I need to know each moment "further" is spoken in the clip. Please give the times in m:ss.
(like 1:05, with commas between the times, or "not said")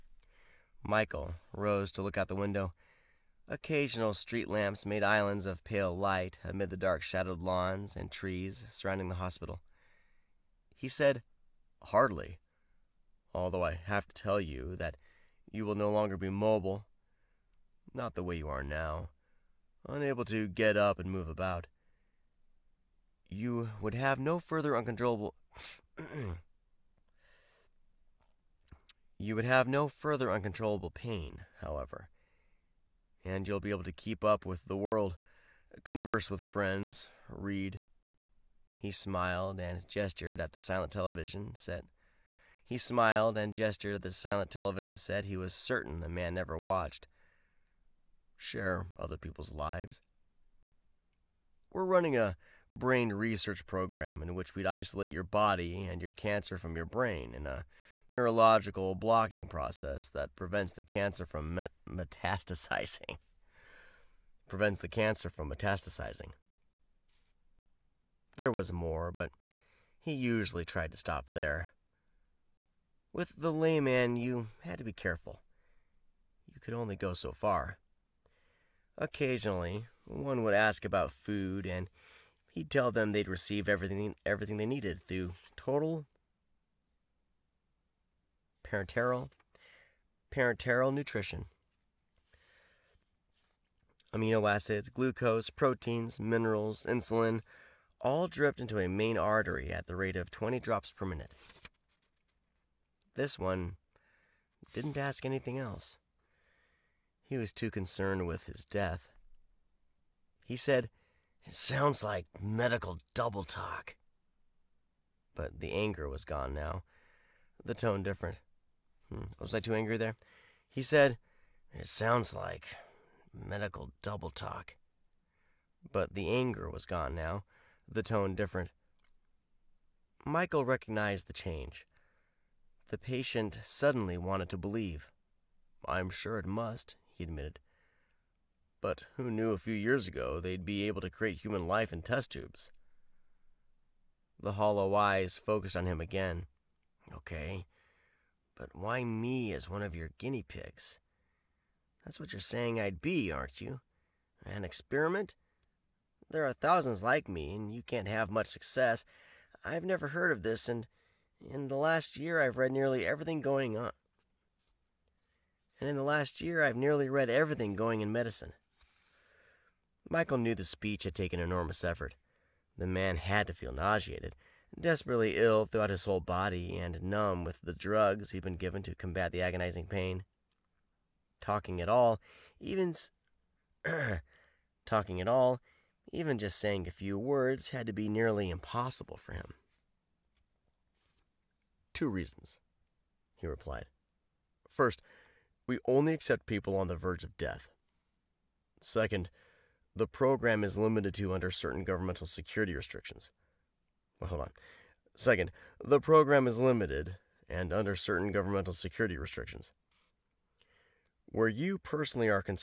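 0:24, 0:29.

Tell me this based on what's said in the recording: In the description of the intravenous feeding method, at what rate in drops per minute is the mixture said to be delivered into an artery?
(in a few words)
20.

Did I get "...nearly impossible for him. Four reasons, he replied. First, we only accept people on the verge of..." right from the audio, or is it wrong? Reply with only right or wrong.
wrong.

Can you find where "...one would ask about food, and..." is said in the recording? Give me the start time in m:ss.
1:20.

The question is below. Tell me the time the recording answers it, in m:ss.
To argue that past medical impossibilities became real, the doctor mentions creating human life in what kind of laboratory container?
2:22.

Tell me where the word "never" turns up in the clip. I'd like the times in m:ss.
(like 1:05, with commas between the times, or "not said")
0:46, 2:39.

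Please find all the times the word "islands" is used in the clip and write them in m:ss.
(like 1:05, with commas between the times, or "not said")
0:05.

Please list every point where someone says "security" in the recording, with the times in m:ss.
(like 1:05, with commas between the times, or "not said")
3:22, 3:28.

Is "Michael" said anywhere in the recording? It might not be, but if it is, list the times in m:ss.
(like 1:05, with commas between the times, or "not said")
0:00, 2:10, 2:50.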